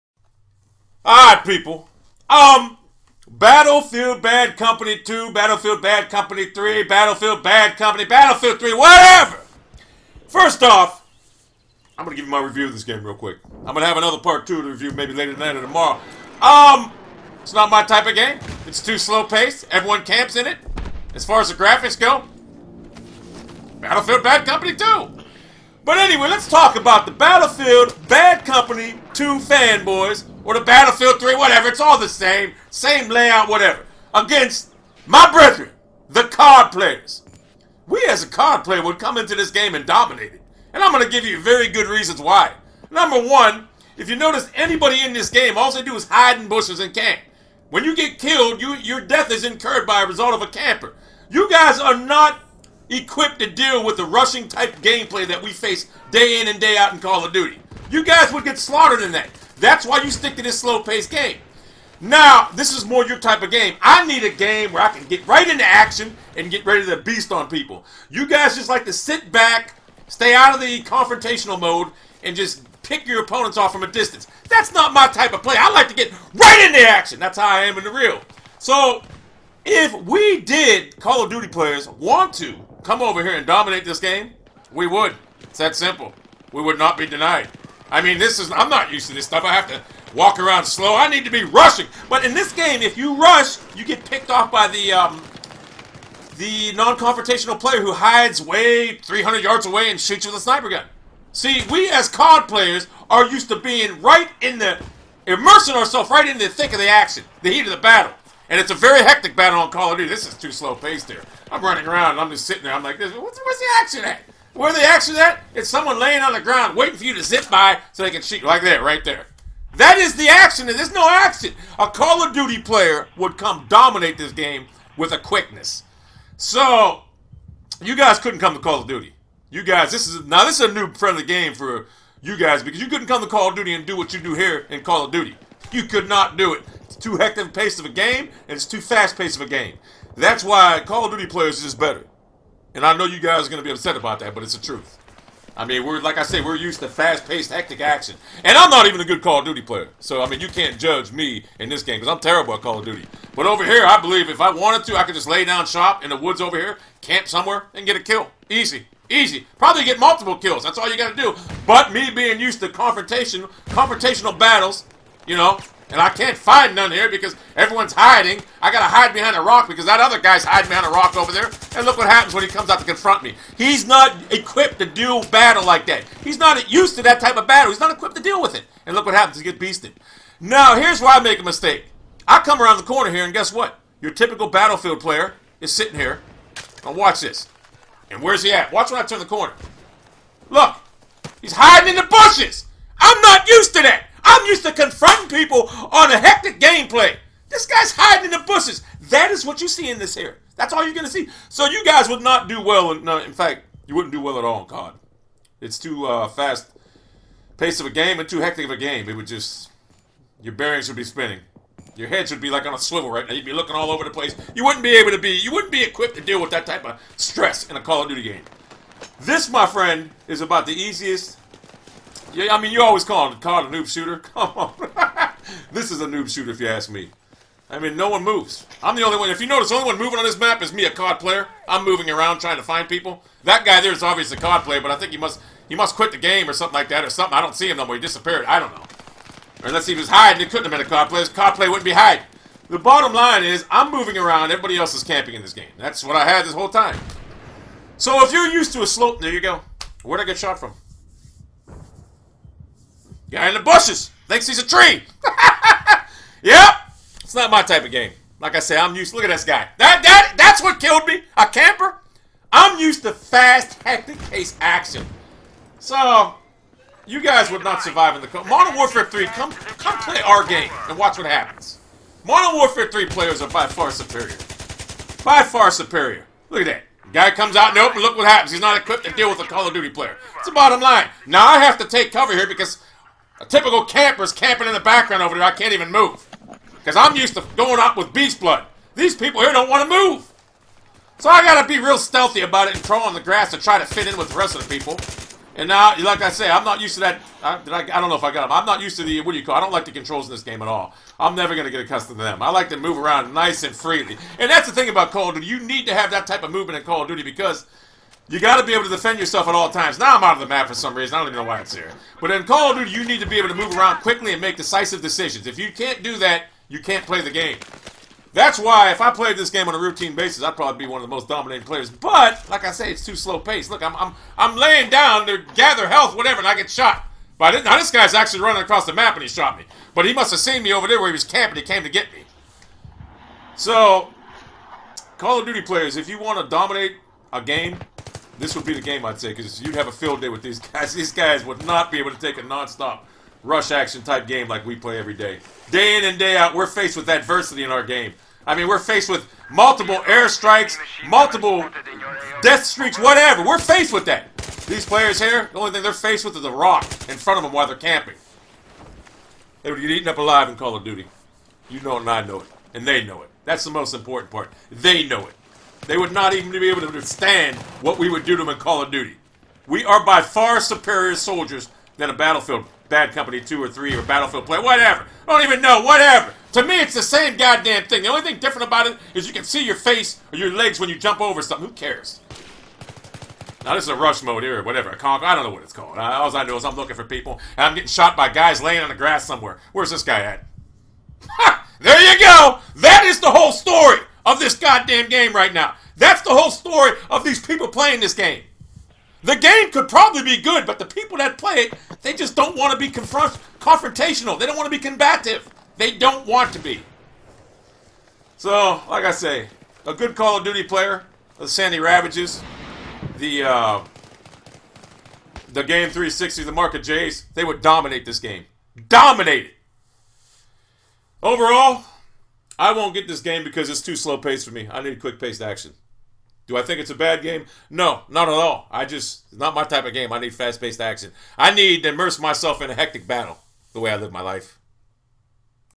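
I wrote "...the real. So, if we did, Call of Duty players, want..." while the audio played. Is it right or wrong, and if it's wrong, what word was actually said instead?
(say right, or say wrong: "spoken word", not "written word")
right.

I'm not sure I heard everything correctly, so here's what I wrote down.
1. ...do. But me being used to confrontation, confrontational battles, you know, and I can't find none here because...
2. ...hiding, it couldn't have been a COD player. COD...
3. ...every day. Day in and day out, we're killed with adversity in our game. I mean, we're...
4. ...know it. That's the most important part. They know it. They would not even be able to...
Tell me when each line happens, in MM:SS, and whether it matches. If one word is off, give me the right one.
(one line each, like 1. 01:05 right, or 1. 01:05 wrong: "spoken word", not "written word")
1. 02:41 right
2. 04:00 right
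3. 05:44 wrong: "faced", not "killed"
4. 06:03 right.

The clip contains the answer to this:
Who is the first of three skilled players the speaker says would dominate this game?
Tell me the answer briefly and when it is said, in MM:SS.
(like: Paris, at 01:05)
Sandy Ravages, at 06:51.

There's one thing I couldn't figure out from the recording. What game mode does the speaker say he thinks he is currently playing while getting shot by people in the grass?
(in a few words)
rush mode.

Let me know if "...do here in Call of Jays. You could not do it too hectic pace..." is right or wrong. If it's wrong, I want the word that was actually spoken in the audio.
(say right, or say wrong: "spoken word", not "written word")
wrong: "Duty", not "Jays".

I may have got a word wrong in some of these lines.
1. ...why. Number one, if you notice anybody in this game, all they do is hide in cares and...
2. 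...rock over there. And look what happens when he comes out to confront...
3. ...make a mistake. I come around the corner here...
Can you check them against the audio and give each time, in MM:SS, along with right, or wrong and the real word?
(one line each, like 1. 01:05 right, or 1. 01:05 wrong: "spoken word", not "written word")
1. 00:42 wrong: "bushes", not "cares"
2. 02:50 right
3. 03:01 right.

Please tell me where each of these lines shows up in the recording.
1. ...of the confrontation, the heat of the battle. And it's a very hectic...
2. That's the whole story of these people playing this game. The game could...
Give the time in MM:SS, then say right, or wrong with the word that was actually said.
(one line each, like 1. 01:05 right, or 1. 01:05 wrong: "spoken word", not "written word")
1. 01:46 wrong: "action", not "confrontation"
2. 06:35 right.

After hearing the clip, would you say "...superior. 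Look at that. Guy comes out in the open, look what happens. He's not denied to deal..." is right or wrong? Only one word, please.
wrong.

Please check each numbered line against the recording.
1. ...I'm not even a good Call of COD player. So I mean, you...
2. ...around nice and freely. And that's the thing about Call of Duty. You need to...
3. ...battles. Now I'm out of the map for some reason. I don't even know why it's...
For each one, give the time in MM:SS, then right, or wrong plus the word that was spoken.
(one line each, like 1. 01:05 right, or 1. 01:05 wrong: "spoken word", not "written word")
1. 02:28 wrong: "Duty", not "COD"
2. 05:02 right
3. 05:09 wrong: "times", not "battles".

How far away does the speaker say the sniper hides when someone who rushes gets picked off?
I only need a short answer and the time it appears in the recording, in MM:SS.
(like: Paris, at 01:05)
300 yards, at 01:38.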